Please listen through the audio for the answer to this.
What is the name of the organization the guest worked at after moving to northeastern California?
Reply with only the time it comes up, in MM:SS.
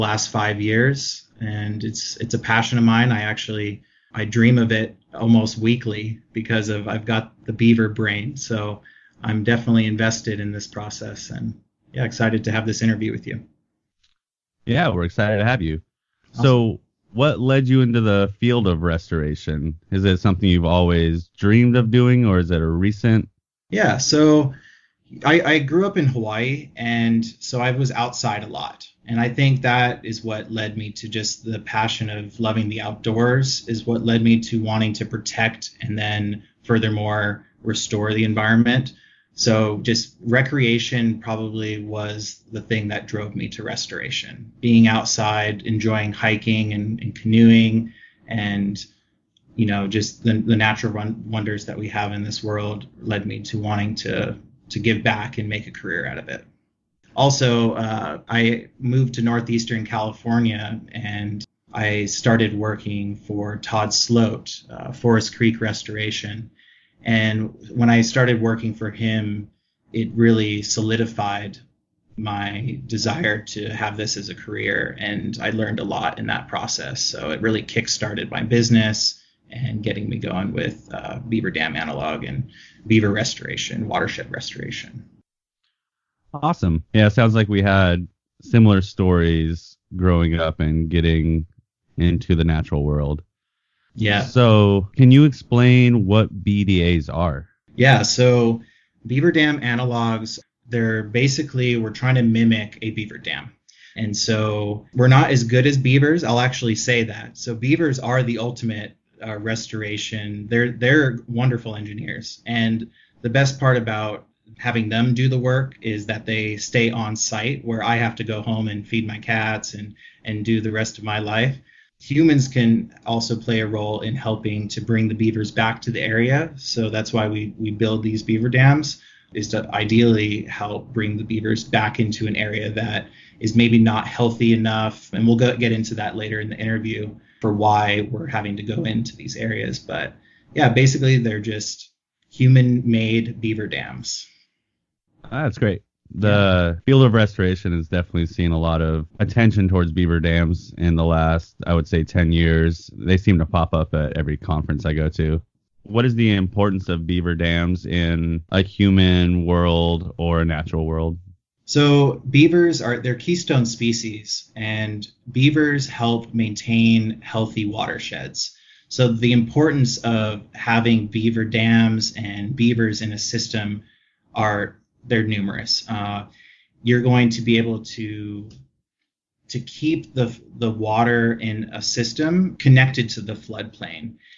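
01:04.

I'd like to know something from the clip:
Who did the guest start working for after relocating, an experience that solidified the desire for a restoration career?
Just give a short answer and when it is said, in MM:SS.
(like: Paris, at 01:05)
Todd Sloat, at 01:03.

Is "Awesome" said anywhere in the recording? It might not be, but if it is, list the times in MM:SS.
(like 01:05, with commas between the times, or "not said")
00:16, 01:26.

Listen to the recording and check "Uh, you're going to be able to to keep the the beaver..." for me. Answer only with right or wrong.
wrong.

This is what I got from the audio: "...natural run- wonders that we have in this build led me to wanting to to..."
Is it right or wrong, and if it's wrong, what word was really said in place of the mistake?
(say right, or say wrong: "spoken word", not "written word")
wrong: "world", not "build".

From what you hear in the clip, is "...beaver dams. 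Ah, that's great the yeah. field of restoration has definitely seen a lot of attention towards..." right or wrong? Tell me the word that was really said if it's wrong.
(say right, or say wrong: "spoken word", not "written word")
right.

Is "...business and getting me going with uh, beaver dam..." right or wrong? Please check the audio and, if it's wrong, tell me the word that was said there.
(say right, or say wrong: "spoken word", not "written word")
right.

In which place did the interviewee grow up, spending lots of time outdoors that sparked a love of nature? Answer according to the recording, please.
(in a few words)
Hawaii.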